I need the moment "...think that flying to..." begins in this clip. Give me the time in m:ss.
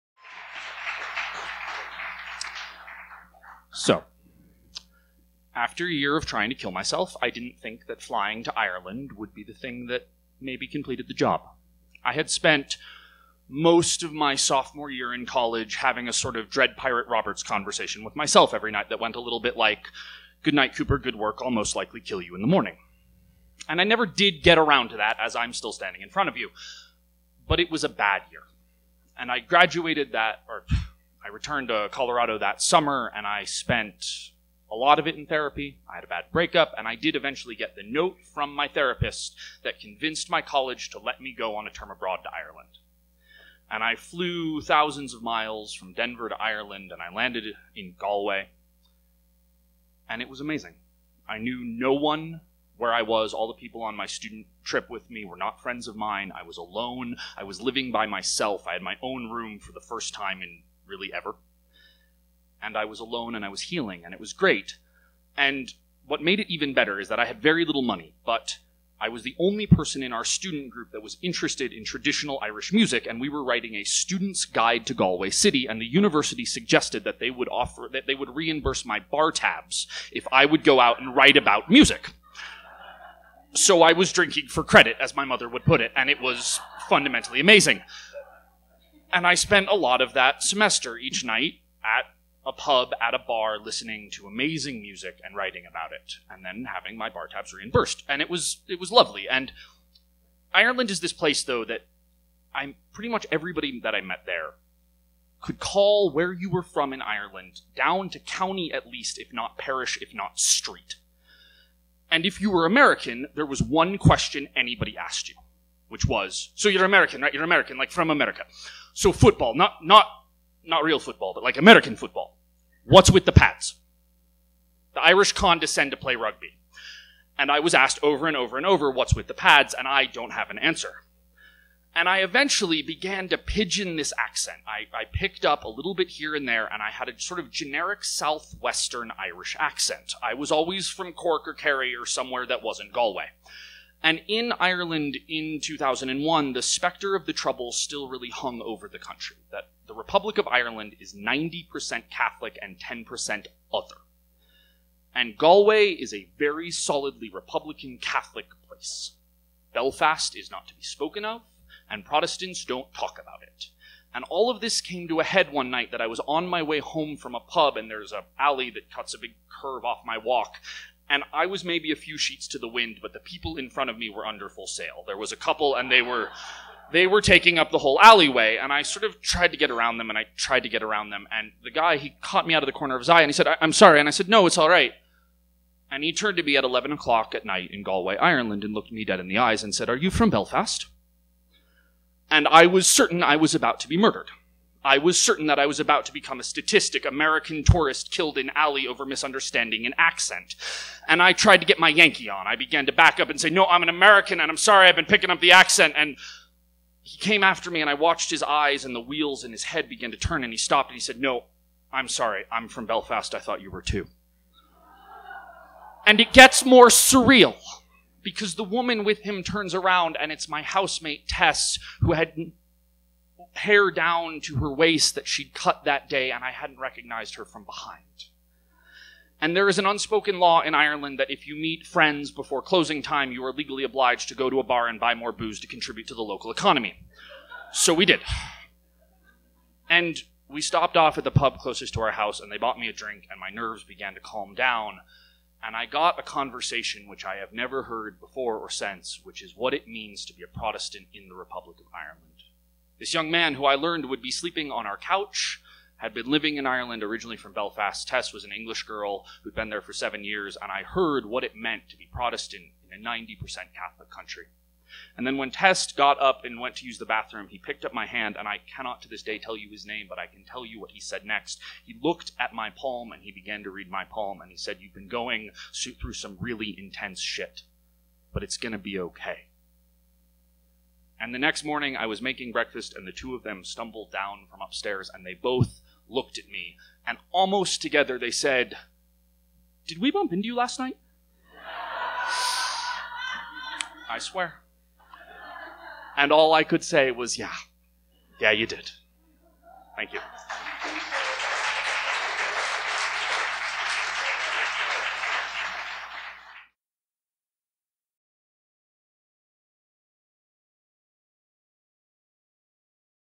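0:07.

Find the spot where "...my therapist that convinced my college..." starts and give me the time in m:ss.
0:38.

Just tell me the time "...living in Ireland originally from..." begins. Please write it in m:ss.
4:16.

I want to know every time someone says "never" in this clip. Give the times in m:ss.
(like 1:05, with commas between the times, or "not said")
0:23, 4:07.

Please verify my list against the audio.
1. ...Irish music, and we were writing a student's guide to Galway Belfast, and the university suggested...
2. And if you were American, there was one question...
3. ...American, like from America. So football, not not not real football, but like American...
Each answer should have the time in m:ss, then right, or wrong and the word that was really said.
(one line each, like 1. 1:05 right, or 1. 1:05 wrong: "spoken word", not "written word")
1. 1:12 wrong: "City", not "Belfast"
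2. 1:52 right
3. 1:57 right.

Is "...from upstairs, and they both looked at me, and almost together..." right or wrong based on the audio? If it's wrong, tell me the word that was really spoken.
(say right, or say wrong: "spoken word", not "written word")
right.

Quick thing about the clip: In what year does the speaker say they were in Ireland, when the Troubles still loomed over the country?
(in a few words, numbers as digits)
2001.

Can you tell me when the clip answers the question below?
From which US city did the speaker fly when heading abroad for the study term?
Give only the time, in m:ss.
0:45.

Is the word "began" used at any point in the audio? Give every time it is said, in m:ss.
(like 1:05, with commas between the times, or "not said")
2:12, 3:22, 3:29, 4:03, 4:33.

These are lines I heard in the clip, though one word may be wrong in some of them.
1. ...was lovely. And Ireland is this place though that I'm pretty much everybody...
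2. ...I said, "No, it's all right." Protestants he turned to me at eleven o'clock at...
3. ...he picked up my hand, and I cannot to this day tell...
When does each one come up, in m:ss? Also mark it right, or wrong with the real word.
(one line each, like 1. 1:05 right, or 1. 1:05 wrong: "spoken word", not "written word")
1. 1:38 right
2. 3:04 wrong: "And", not "Protestants"
3. 4:27 right.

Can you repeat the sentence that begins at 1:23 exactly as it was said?
So I was drinking for credit, as my mother would put it, and it was fundamentally amazing.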